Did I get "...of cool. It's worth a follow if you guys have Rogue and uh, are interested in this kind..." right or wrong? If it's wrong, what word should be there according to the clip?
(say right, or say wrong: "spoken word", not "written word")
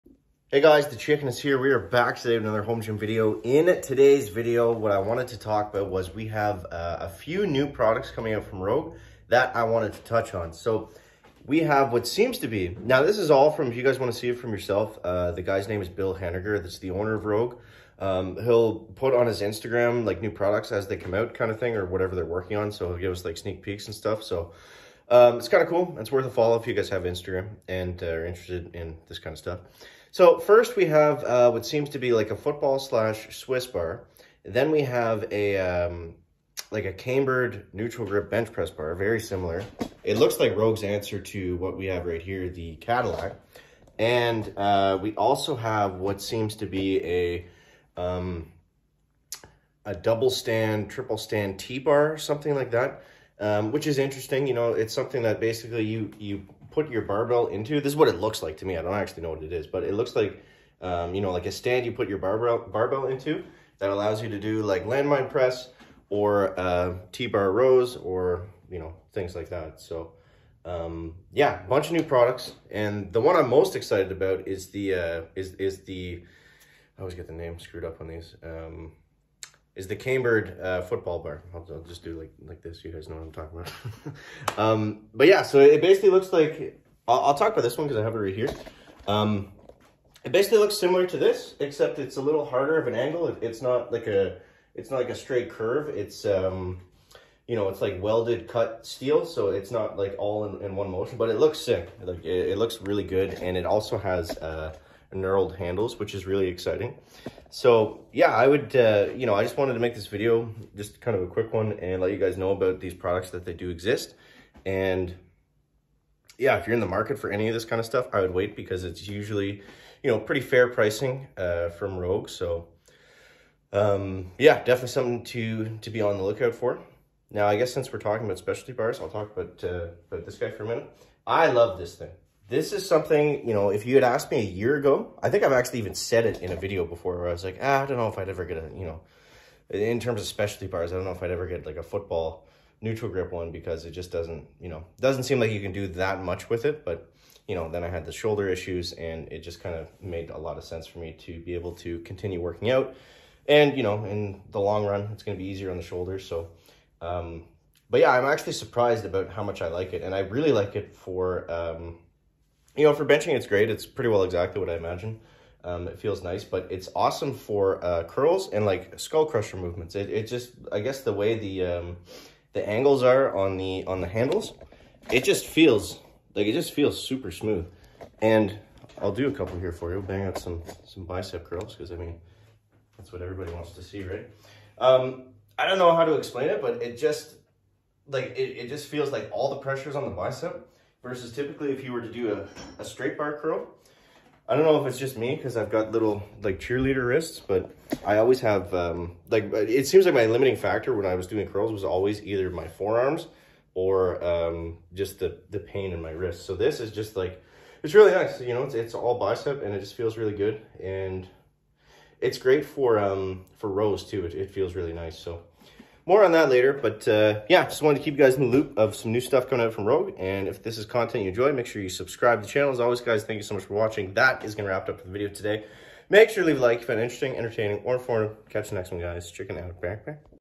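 wrong: "Instagram", not "Rogue".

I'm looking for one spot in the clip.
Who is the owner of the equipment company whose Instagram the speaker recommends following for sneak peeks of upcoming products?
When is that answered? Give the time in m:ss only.
0:15.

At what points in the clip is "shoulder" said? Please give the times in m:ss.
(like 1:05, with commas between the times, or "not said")
2:28, 2:35.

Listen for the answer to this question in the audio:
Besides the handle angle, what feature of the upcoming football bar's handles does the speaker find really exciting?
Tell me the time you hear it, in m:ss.
1:45.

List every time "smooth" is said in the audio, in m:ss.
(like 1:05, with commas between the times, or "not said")
2:57.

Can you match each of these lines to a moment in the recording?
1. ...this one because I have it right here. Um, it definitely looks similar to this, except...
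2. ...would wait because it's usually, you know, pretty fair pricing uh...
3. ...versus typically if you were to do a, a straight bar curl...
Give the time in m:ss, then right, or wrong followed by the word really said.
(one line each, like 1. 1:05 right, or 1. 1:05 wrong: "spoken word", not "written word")
1. 1:27 wrong: "basically", not "definitely"
2. 1:58 right
3. 3:11 right.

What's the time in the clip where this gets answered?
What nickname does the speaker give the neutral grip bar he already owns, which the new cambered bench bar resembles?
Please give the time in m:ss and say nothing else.
0:42.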